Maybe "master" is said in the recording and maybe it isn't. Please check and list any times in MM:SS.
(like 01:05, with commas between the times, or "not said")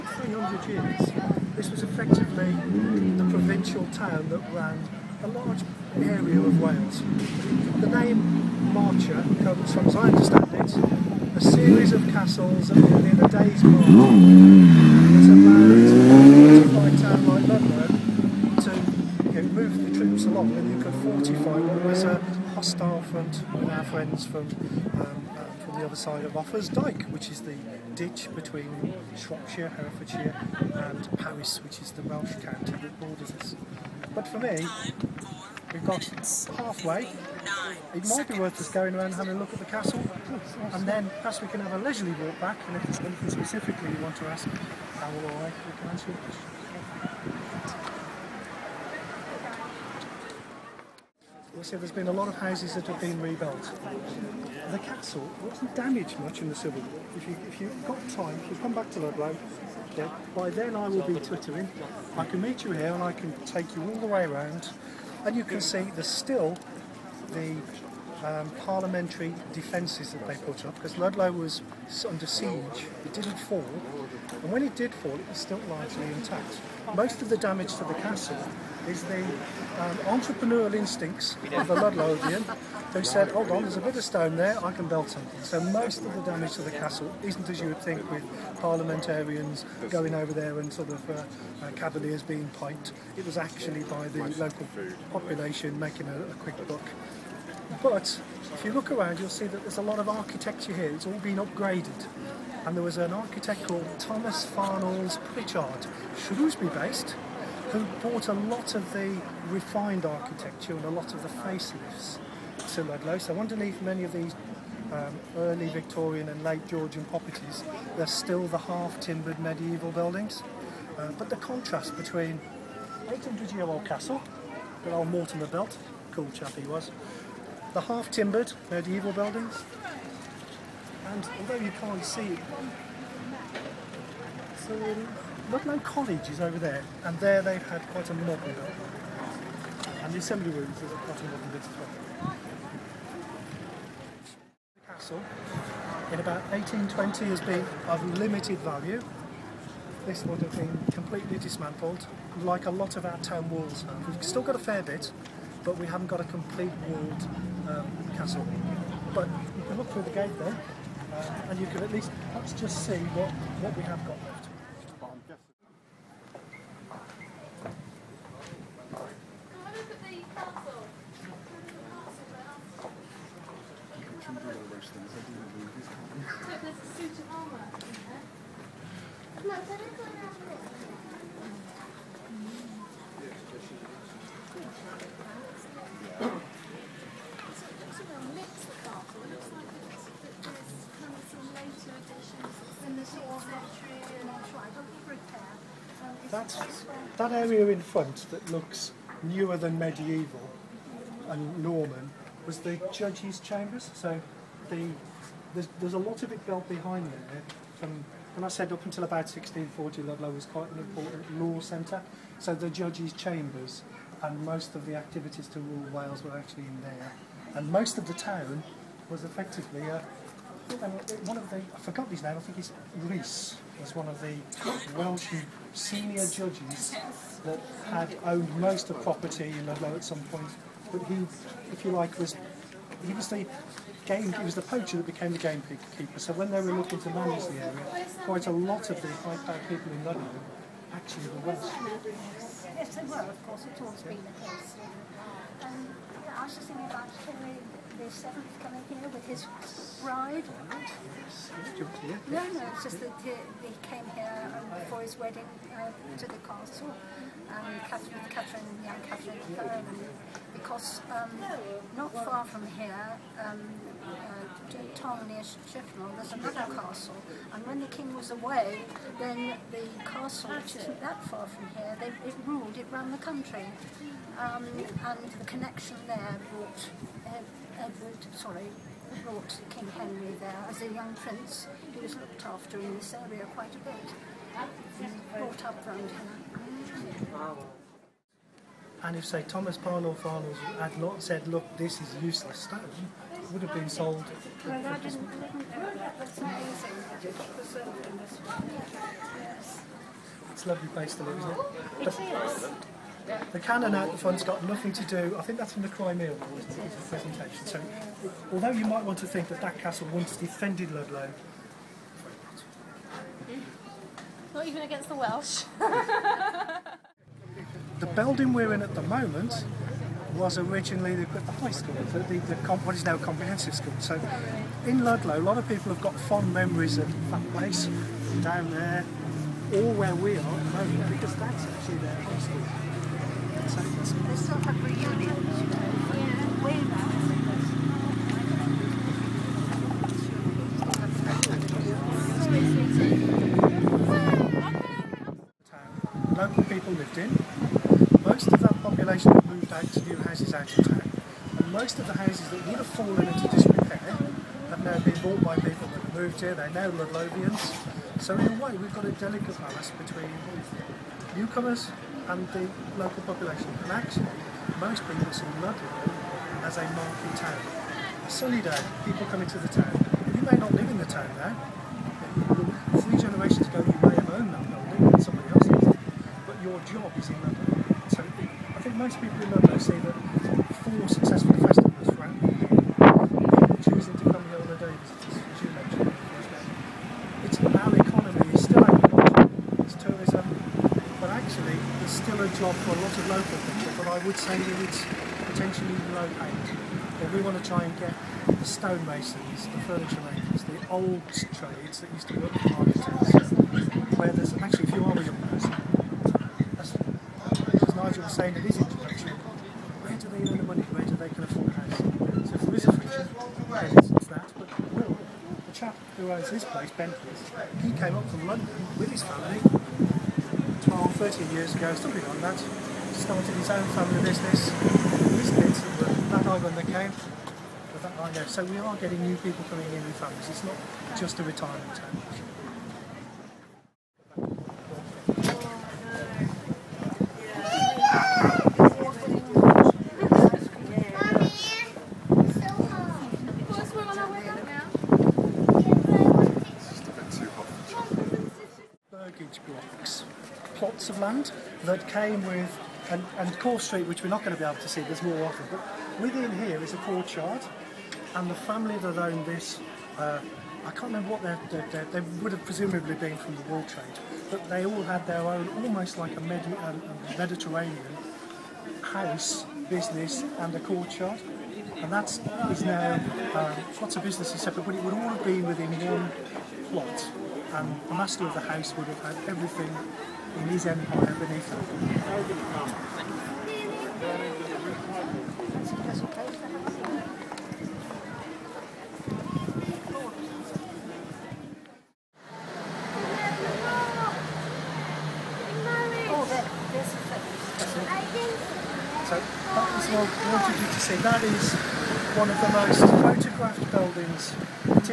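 07:58.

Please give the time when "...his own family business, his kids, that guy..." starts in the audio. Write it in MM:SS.
07:03.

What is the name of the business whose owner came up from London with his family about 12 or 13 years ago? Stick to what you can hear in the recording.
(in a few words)
Bentley's.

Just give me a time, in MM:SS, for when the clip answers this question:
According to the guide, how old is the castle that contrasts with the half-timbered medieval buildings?
02:03.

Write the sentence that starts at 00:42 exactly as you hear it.
And if there's anything specifically you want to ask, I will always we can answer your question.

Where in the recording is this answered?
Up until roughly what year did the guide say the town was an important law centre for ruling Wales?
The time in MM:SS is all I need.
03:29.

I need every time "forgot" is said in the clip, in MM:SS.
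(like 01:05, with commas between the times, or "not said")
03:41.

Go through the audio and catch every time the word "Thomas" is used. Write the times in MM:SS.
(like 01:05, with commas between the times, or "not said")
01:43, 04:49.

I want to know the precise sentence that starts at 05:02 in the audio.
It is not it The cannon out the front's got nothing to do, I think that's in the Crimea War presentation.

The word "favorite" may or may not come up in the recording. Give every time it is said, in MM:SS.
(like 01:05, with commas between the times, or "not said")
not said.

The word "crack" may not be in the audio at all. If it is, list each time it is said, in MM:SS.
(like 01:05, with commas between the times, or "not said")
not said.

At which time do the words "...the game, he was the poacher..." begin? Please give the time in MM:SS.
03:53.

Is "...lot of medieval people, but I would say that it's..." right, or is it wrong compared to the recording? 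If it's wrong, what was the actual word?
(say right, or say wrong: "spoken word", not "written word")
wrong: "local", not "medieval".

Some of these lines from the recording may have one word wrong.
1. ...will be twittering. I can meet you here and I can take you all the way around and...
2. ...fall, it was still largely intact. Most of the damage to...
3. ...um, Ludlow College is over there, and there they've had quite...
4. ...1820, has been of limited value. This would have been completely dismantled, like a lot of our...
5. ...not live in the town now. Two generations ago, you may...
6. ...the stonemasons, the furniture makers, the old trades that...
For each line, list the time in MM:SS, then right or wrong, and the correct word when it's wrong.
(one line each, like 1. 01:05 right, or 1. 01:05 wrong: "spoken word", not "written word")
1. 01:00 right
2. 01:14 right
3. 02:14 right
4. 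02:26 right
5. 06:10 wrong: "Three", not "Two"
6. 06:38 right.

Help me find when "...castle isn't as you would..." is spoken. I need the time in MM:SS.
01:26.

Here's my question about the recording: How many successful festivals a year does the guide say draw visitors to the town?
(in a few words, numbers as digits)
4.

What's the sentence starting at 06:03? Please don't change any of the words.
And actually, most people see Ludlow as a market town.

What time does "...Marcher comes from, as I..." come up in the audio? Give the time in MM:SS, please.
00:08.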